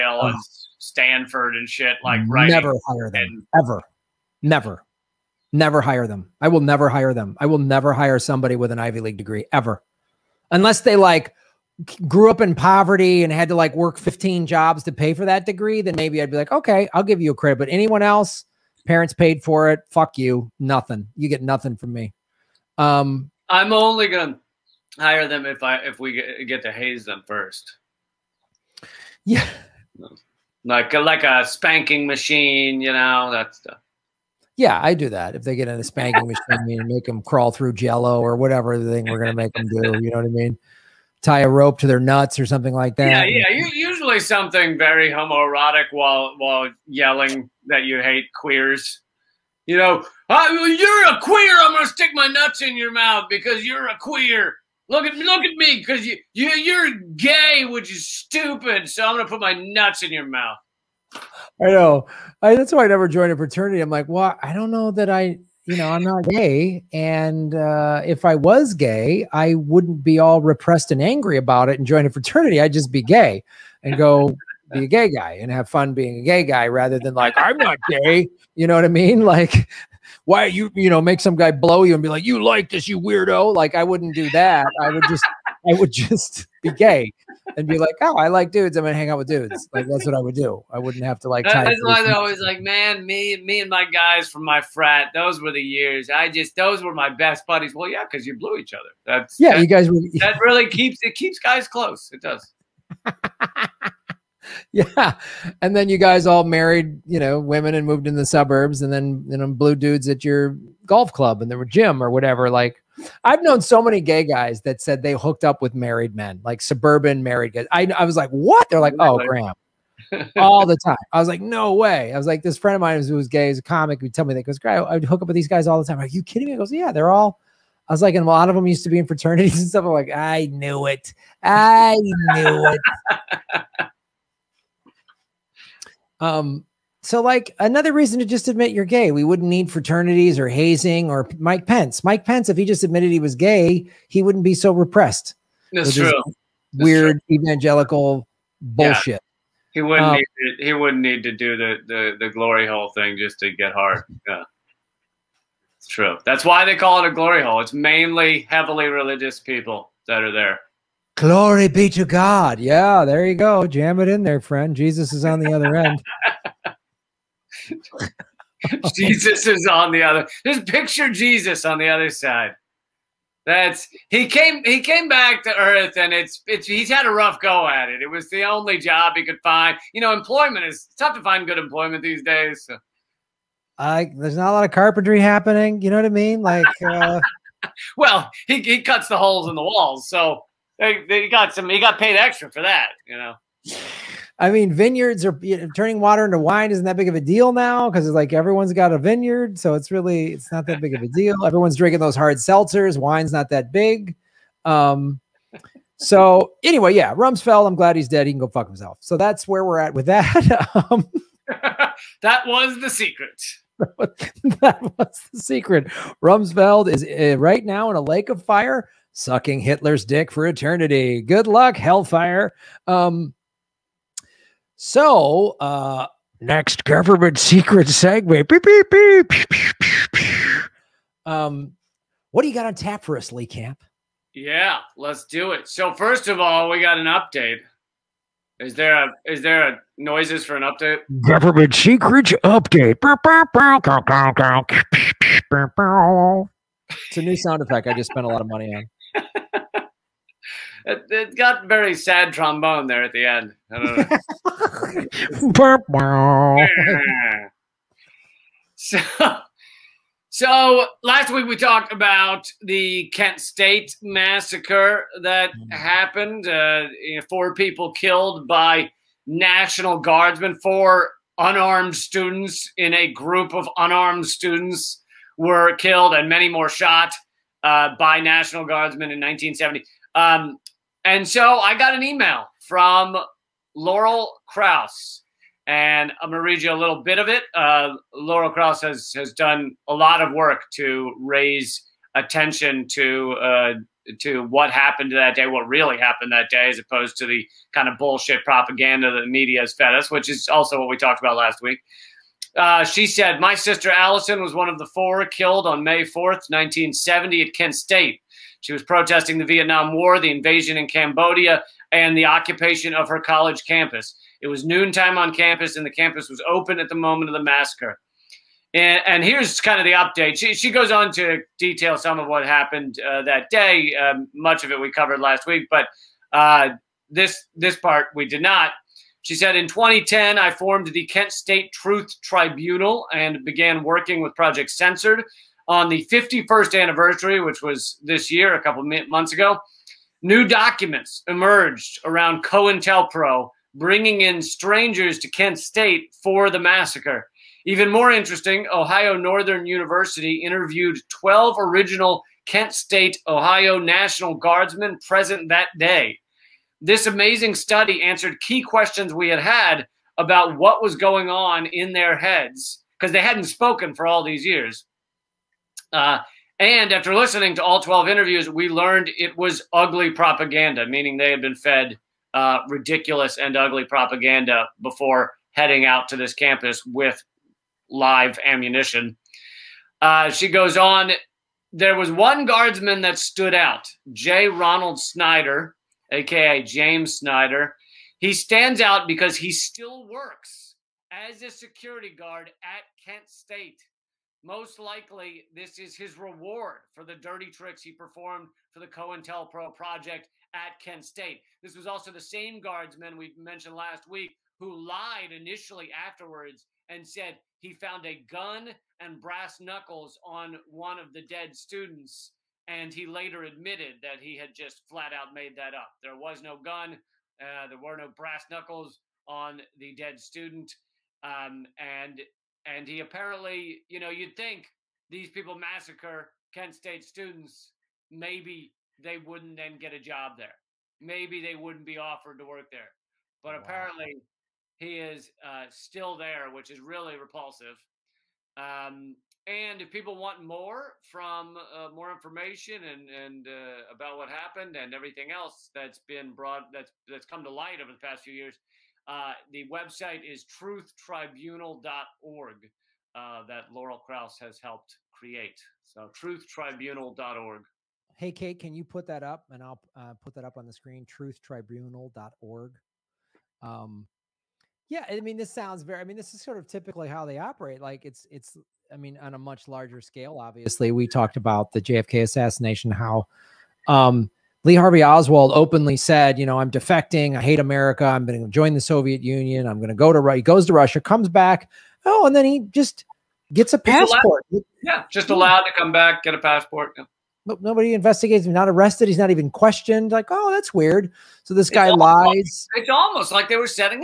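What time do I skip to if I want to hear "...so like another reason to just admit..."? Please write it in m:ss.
2:17.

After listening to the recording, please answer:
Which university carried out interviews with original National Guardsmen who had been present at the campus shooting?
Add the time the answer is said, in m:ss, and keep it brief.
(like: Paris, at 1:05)
Ohio Northern University, at 5:48.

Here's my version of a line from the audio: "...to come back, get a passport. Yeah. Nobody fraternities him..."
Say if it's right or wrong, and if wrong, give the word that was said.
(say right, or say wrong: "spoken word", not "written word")
wrong: "investigates", not "fraternities".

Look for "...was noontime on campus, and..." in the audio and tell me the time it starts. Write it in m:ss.
5:14.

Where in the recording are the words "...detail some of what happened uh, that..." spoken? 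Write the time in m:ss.
5:21.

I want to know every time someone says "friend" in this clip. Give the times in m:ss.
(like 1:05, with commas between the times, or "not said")
2:02, 2:44.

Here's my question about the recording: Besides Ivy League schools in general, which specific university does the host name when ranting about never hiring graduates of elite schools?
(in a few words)
Stanford.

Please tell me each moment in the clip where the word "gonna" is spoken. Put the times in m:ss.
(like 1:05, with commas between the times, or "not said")
0:24, 0:51, 0:59, 1:28, 4:46.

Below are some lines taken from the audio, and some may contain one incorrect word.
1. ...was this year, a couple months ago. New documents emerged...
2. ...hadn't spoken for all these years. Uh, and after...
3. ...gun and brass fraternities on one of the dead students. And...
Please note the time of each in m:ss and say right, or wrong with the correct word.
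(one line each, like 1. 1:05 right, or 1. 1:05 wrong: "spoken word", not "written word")
1. 5:37 right
2. 6:03 right
3. 6:48 wrong: "knuckles", not "fraternities".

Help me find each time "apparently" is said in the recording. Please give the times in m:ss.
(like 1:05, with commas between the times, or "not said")
7:02, 7:13.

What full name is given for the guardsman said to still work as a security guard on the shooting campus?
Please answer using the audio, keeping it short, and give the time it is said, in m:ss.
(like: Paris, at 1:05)
J. Ronald Snyder, at 6:24.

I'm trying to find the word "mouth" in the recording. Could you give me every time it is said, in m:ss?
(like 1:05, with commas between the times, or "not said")
0:52, 1:00.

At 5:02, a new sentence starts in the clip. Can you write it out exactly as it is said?
Uh, she said, "My sister Allison was one of the four killed on May 4th, 1970, at Kent State.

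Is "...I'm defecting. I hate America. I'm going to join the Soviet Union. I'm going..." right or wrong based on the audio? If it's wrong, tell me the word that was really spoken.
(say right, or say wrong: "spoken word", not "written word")
right.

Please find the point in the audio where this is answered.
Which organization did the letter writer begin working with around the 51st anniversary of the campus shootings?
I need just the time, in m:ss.
5:34.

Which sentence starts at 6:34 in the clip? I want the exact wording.
Most likely, this is his reward for the dirty tricks he performed for the COINTELPRO project at Kent State.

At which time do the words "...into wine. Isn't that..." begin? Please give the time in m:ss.
3:16.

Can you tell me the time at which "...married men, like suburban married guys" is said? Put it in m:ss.
1:55.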